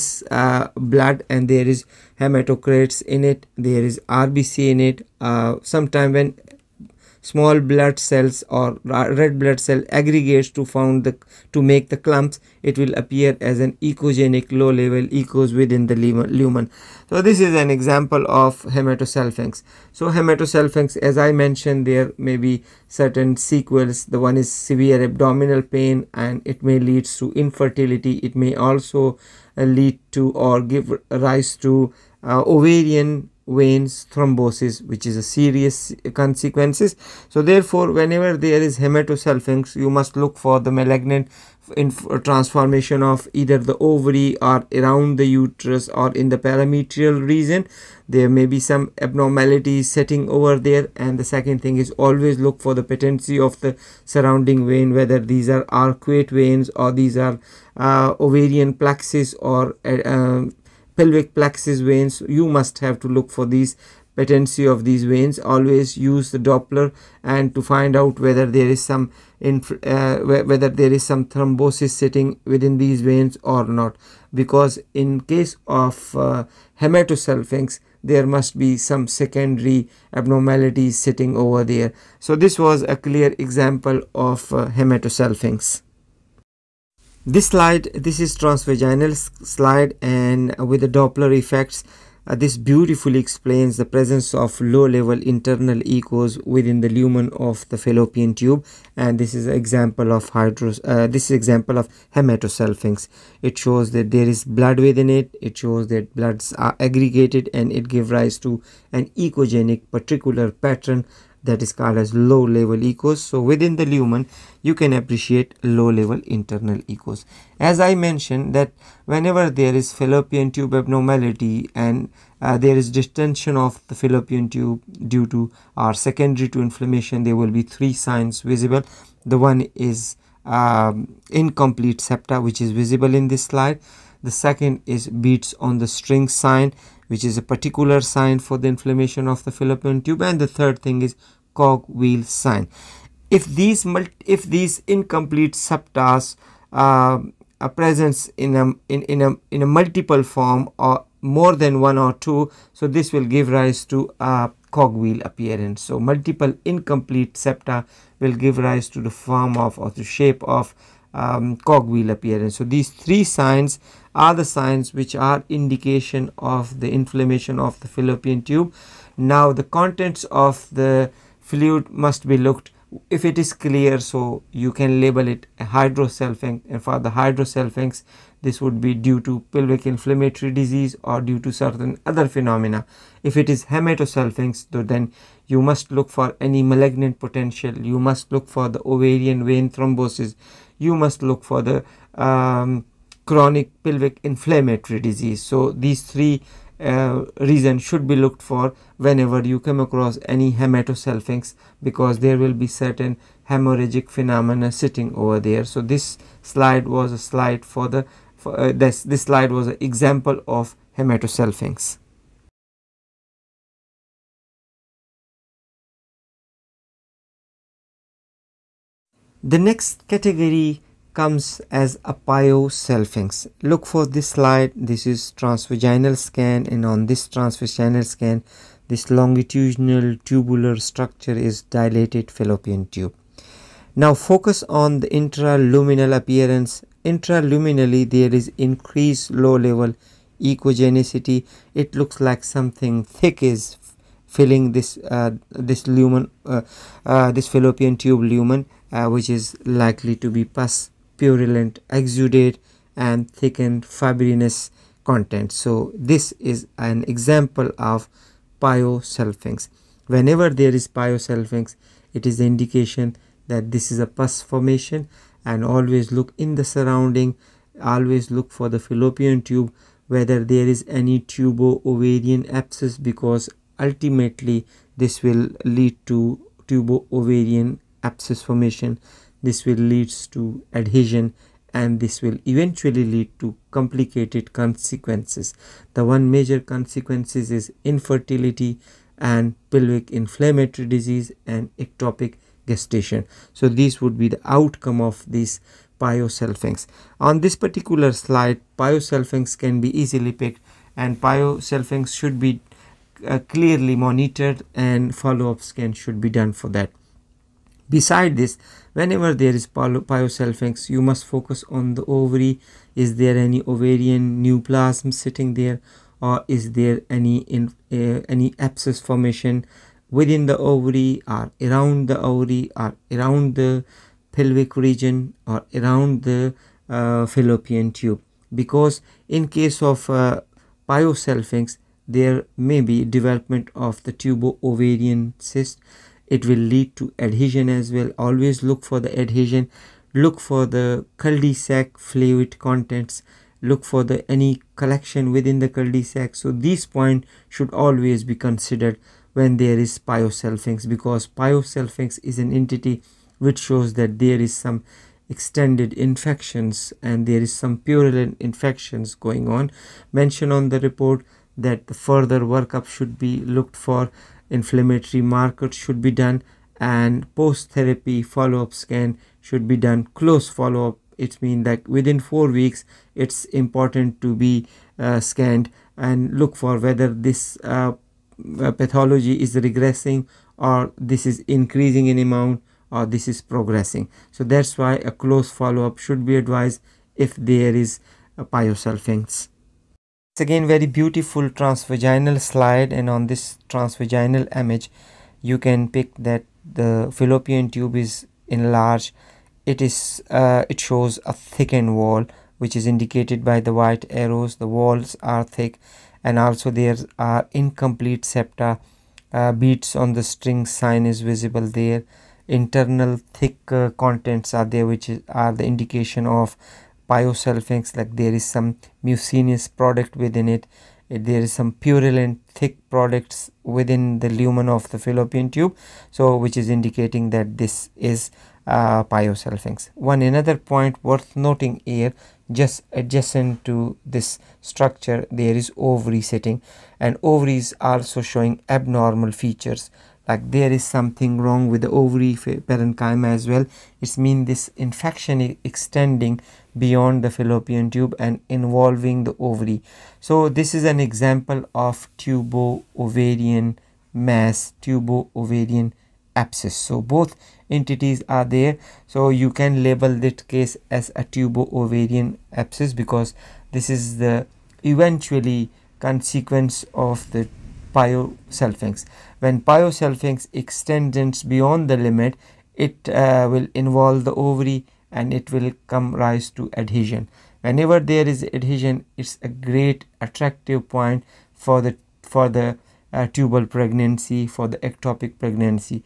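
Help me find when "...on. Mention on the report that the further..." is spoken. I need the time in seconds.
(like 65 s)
359 s.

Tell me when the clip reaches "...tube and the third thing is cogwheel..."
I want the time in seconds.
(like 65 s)
139 s.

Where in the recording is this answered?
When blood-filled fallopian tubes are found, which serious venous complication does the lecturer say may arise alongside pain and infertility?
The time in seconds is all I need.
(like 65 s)
32 s.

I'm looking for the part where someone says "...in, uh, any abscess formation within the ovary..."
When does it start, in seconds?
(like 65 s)
317 s.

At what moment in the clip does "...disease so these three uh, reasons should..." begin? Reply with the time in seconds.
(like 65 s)
194 s.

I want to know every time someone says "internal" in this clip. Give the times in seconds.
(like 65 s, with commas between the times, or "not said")
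95 s, 116 s, 412 s.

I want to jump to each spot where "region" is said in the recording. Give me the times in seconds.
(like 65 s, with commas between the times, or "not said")
47 s, 324 s.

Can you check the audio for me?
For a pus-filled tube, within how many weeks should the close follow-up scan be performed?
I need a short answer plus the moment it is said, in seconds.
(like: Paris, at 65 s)
4 weeks, at 372 s.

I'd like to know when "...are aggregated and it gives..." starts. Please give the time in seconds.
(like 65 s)
106 s.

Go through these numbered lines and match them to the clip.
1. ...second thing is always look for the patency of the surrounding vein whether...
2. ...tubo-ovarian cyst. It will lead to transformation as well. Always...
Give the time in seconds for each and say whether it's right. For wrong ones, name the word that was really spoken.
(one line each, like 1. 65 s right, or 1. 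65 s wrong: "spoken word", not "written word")
1. 51 s right
2. 334 s wrong: "adhesion", not "transformation".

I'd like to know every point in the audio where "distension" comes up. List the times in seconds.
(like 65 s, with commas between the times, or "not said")
122 s.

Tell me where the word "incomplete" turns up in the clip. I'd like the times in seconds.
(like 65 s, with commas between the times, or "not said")
131 s, 144 s, 156 s, 407 s.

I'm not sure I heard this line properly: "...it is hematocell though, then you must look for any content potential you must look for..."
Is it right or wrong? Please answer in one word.
wrong.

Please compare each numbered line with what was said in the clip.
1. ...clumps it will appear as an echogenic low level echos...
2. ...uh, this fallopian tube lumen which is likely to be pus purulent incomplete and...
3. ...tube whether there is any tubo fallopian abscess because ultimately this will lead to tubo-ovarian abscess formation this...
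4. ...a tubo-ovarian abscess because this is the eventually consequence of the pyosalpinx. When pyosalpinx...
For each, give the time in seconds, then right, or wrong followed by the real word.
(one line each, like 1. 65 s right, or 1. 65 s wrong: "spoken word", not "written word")
1. 11 s right
2. 247 s wrong: "exudate", not "incomplete"
3. 269 s wrong: "ovarian", not "fallopian"
4. 461 s right.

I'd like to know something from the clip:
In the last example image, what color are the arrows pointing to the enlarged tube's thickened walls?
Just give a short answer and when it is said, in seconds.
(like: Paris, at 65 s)
White, at 403 s.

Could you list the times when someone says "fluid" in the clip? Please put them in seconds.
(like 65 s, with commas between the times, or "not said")
171 s, 341 s.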